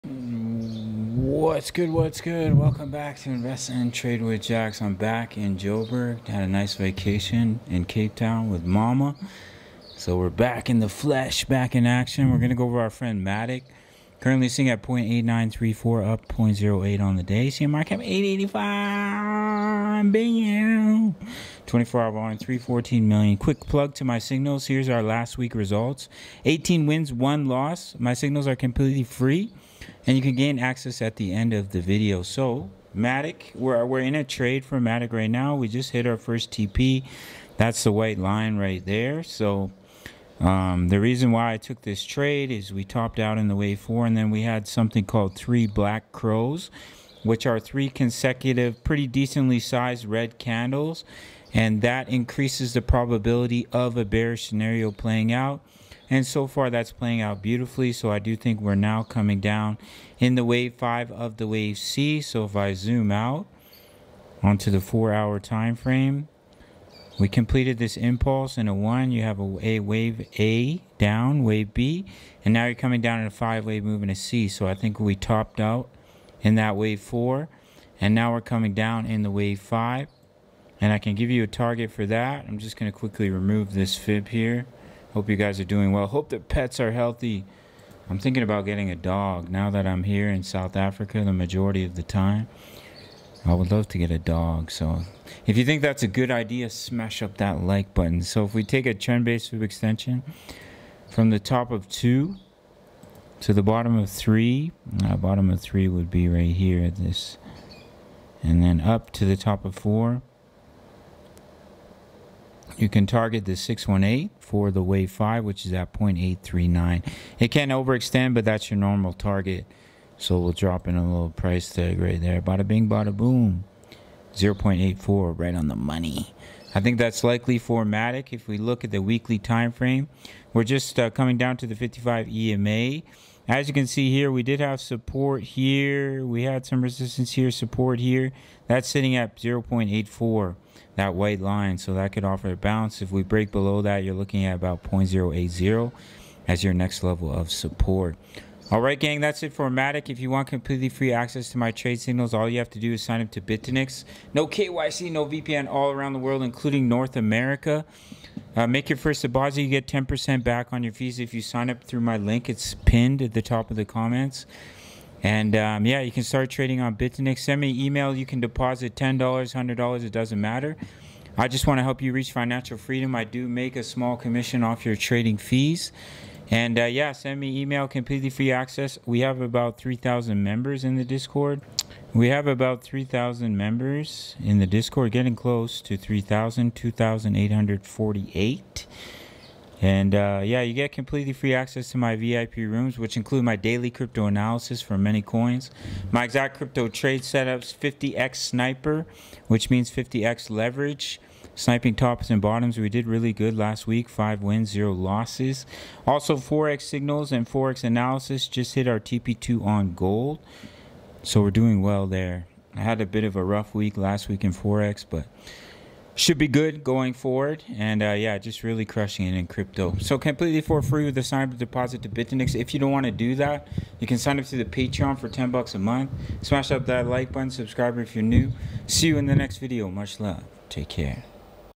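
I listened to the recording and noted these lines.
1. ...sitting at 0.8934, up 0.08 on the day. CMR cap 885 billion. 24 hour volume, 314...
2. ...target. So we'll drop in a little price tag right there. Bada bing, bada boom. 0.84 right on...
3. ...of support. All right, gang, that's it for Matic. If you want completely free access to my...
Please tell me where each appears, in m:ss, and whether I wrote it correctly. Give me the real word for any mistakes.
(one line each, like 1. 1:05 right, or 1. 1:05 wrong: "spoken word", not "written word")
1. 0:14 right
2. 1:59 right
3. 2:27 right.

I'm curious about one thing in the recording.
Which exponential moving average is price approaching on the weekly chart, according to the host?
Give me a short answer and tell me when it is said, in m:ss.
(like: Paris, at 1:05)
55 EMA, at 2:11.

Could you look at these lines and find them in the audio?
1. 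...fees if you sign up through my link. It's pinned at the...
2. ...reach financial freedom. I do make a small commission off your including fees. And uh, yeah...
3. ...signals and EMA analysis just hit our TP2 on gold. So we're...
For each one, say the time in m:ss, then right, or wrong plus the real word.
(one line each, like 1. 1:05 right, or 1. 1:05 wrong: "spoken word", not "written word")
1. 2:40 right
2. 2:52 wrong: "trading", not "including"
3. 3:26 wrong: "Forex", not "EMA".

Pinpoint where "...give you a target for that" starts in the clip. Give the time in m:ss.
1:21.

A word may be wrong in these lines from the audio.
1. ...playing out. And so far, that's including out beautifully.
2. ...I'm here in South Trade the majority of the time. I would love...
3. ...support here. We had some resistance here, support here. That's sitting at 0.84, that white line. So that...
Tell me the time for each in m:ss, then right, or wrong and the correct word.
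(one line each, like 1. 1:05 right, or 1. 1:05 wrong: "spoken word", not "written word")
1. 0:54 wrong: "playing", not "including"
2. 1:29 wrong: "Africa", not "Trade"
3. 2:14 right.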